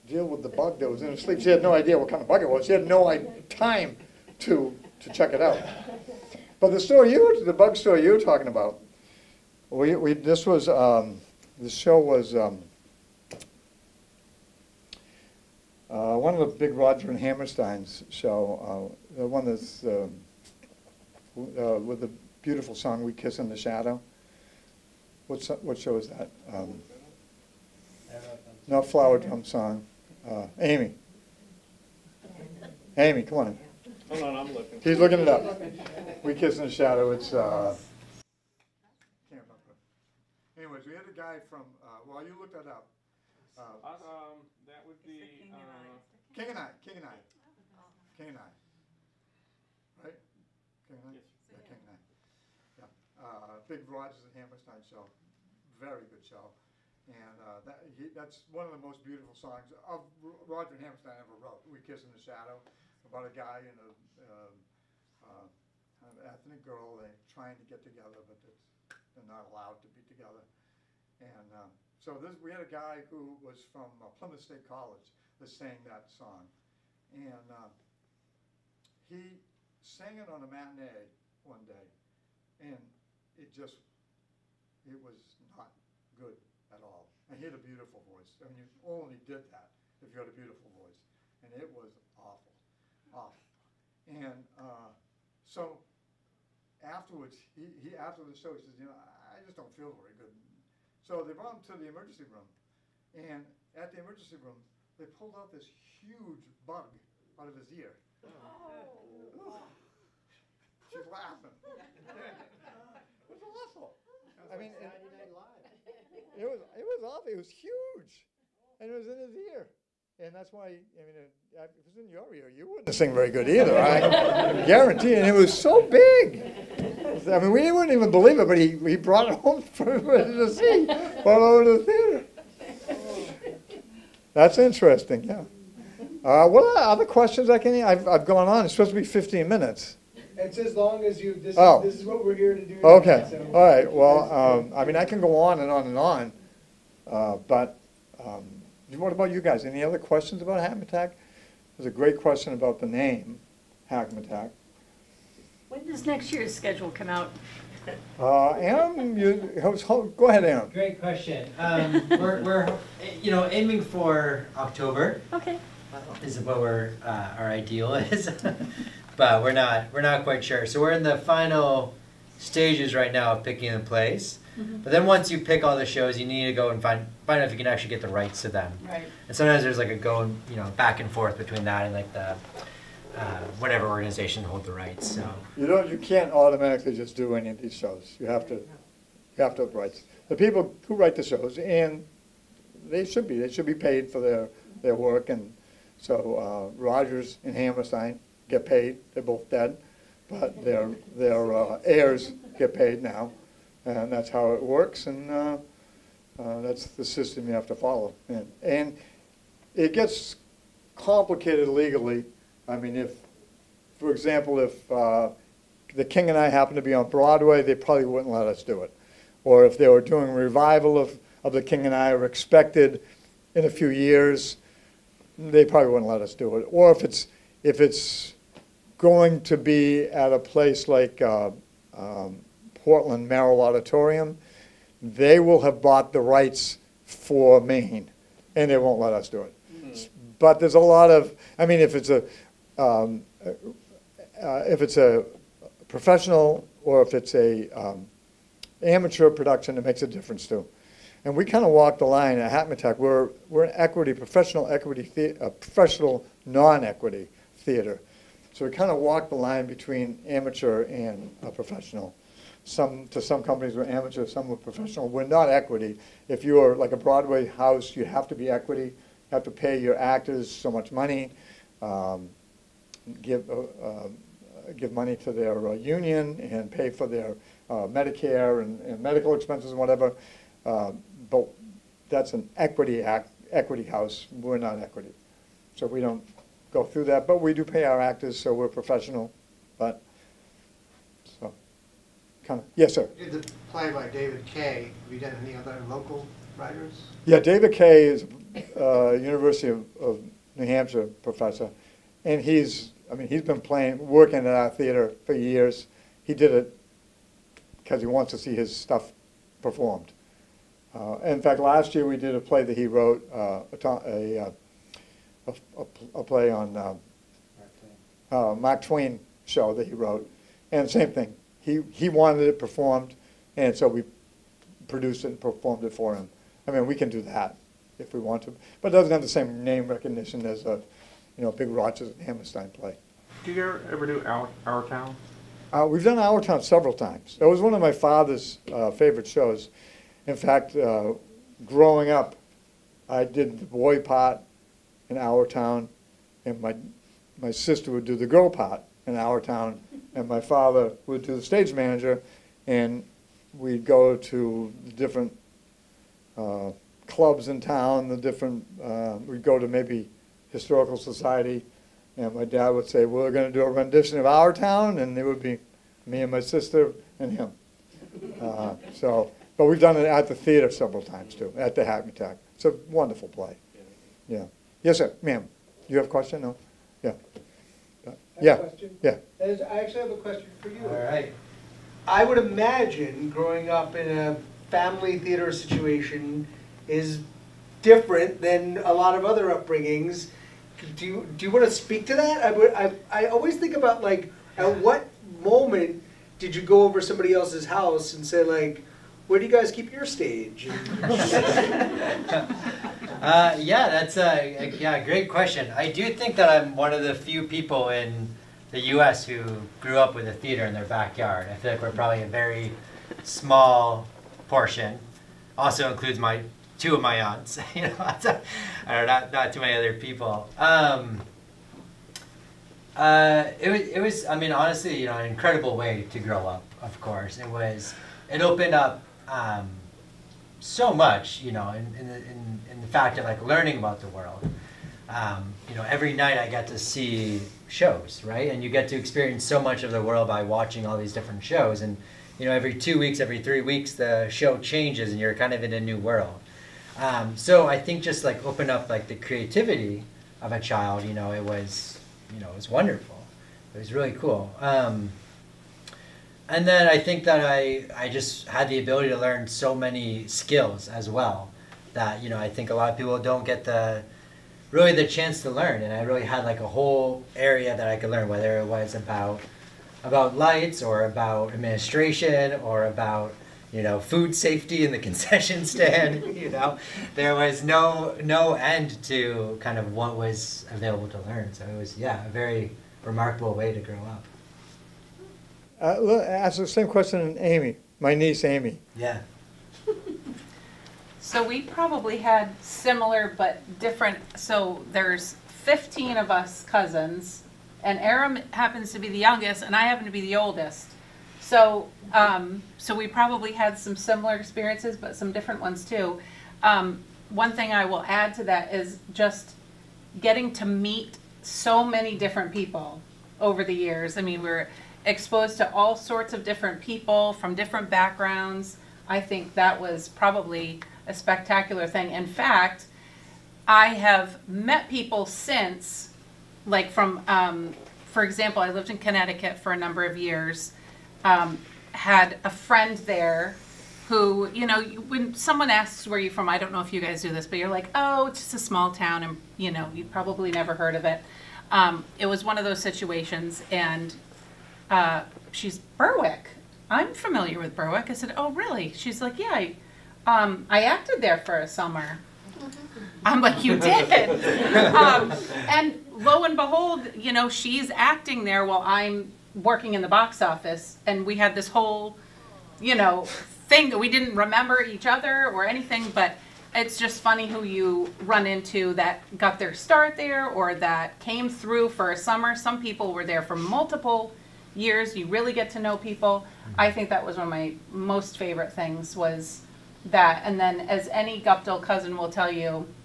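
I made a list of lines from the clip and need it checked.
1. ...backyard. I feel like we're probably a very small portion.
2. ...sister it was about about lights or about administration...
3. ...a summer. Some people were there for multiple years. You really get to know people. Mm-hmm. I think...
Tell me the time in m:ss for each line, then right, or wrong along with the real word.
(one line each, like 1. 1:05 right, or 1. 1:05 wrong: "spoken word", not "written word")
1. 6:50 right
2. 7:48 wrong: "whether", not "sister"
3. 9:32 right.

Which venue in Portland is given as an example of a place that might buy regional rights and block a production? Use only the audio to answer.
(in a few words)
Merrill Auditorium.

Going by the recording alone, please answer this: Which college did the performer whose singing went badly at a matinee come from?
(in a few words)
Plymouth State College.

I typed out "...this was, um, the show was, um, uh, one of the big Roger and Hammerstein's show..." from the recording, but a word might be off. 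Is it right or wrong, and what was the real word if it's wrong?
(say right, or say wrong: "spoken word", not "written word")
right.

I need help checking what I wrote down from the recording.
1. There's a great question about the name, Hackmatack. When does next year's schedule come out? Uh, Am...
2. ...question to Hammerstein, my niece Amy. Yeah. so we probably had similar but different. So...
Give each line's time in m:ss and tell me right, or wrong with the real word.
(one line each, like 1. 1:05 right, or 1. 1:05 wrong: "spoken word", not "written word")
1. 2:31 right
2. 8:06 wrong: "Amy", not "Hammerstein".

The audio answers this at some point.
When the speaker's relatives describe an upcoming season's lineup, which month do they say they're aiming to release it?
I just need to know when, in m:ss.
2:44.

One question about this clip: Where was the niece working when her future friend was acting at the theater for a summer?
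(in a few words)
the box office.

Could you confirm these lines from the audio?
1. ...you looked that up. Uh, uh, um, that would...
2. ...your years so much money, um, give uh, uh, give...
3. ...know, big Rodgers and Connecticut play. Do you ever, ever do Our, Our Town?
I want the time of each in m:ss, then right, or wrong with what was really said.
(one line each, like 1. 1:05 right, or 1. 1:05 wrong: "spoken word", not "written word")
1. 0:42 right
2. 4:29 wrong: "actors", not "years"
3. 5:31 wrong: "Hammerstein", not "Connecticut".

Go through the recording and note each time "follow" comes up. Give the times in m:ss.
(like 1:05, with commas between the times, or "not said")
3:27.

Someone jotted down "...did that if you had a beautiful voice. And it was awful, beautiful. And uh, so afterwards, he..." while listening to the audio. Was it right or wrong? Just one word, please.
wrong.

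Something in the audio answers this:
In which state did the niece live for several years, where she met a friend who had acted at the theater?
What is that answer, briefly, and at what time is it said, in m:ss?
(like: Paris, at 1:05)
Connecticut, at 8:48.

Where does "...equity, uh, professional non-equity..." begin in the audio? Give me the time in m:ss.
4:14.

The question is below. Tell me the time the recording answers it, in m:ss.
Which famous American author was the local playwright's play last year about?
5:18.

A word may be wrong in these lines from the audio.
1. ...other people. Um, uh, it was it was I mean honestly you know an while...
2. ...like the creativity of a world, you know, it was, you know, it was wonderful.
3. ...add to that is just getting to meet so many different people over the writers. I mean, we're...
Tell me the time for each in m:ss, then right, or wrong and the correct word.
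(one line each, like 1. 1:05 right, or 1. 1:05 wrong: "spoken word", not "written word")
1. 6:59 wrong: "incredible", not "while"
2. 7:28 wrong: "child", not "world"
3. 8:28 wrong: "years", not "writers".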